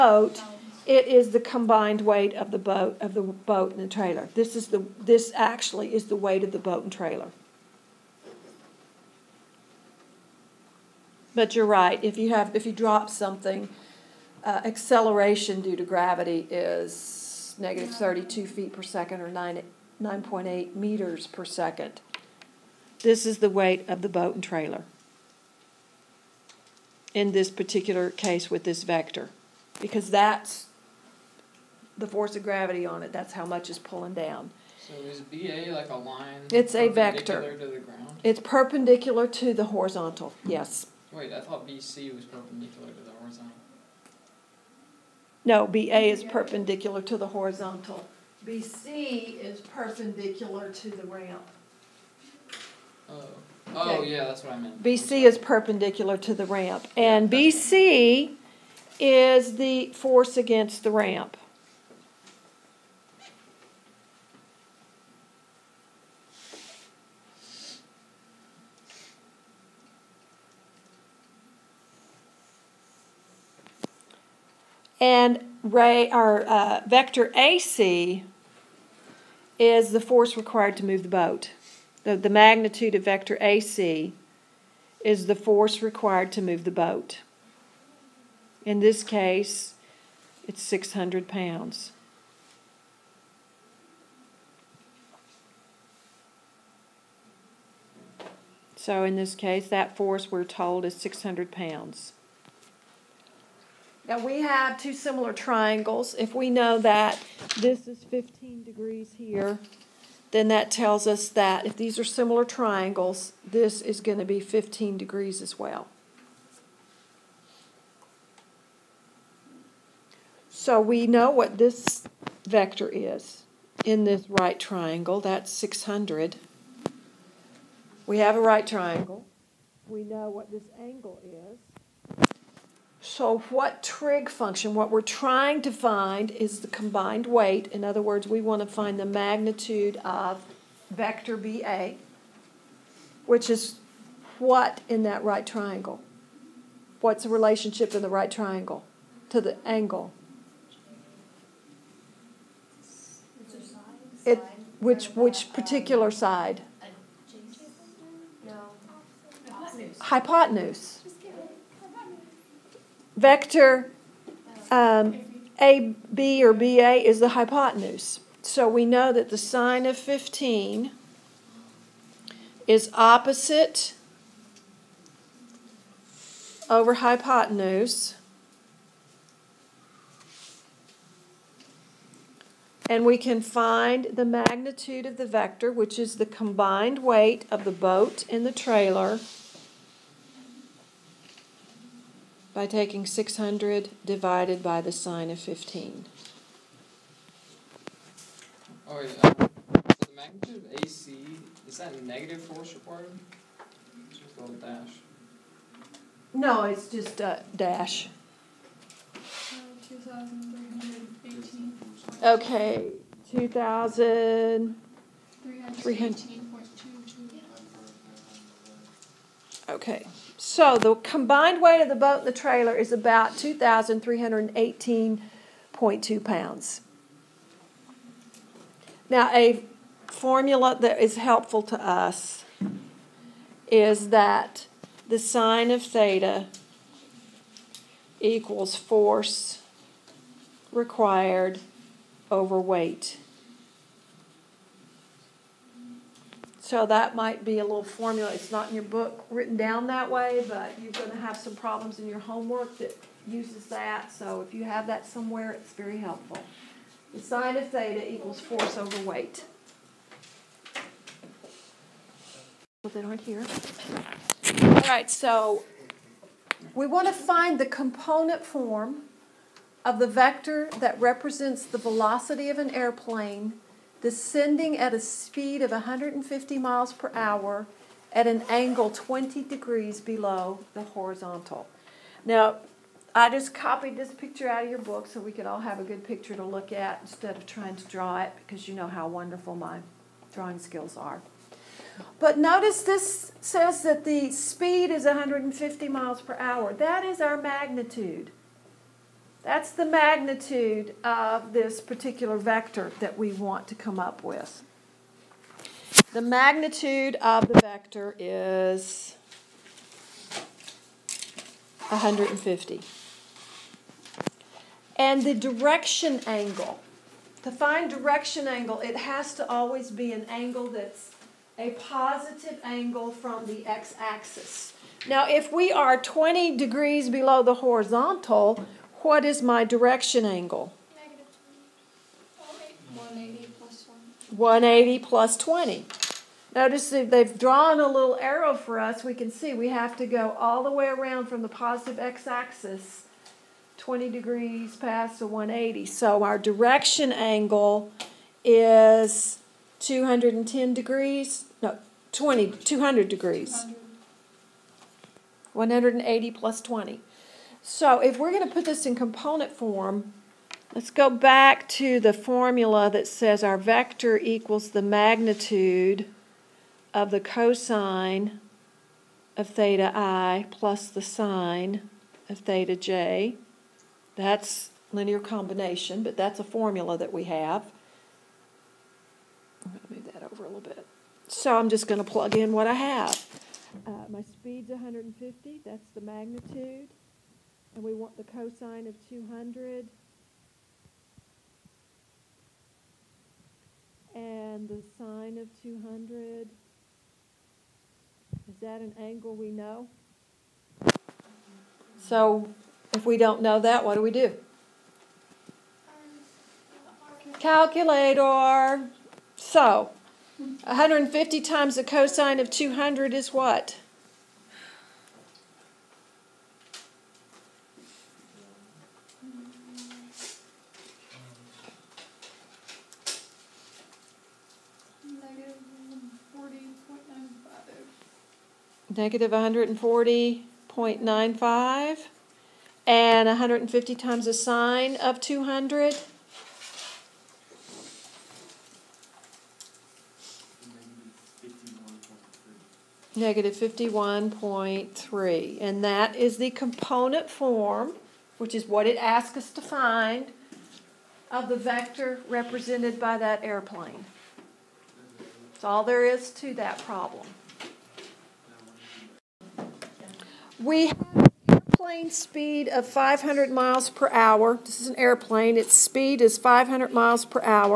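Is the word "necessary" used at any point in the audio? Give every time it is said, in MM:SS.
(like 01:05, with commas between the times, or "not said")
not said.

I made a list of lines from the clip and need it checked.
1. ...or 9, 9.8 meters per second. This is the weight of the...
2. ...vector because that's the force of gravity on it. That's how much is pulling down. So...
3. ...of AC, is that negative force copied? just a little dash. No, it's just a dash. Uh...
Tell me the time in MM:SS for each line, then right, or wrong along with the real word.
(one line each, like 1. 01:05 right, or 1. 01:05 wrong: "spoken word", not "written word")
1. 00:19 right
2. 00:28 right
3. 03:20 wrong: "required", not "copied".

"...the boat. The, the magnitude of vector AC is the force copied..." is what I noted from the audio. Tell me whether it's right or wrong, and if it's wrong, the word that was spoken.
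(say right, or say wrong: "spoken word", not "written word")
wrong: "required", not "copied".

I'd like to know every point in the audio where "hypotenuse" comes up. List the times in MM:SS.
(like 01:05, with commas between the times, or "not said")
02:39, 02:47, 02:56.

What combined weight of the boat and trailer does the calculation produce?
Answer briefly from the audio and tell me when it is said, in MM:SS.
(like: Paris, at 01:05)
about 2,318.2 pounds, at 03:43.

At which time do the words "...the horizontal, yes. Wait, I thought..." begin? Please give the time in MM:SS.
00:39.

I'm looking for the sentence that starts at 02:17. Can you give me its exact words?
In other words, we want to find the magnitude of vector BA, which is what in that right triangle?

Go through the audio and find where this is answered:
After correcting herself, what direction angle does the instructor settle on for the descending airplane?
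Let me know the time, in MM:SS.
05:52.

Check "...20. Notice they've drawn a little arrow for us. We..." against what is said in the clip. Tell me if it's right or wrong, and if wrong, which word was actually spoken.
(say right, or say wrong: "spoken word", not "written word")
right.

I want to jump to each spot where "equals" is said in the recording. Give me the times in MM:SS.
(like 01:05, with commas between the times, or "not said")
03:58, 04:18, 06:04.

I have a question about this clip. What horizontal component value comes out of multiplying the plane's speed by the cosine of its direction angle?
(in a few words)
-140.95.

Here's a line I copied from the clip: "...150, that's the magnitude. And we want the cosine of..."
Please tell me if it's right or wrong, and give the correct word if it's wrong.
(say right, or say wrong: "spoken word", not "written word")
right.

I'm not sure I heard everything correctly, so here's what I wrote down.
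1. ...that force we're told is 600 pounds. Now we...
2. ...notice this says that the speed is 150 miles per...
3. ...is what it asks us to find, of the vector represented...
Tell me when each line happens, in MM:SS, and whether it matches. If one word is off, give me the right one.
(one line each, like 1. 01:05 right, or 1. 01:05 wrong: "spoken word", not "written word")
1. 01:39 right
2. 04:52 right
3. 07:28 right.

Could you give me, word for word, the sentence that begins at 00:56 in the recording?
And BC is the force against the ramp.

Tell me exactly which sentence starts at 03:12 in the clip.
by taking 600 divided by the sine of 15.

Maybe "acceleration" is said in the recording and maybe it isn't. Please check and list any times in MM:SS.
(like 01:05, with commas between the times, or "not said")
00:14.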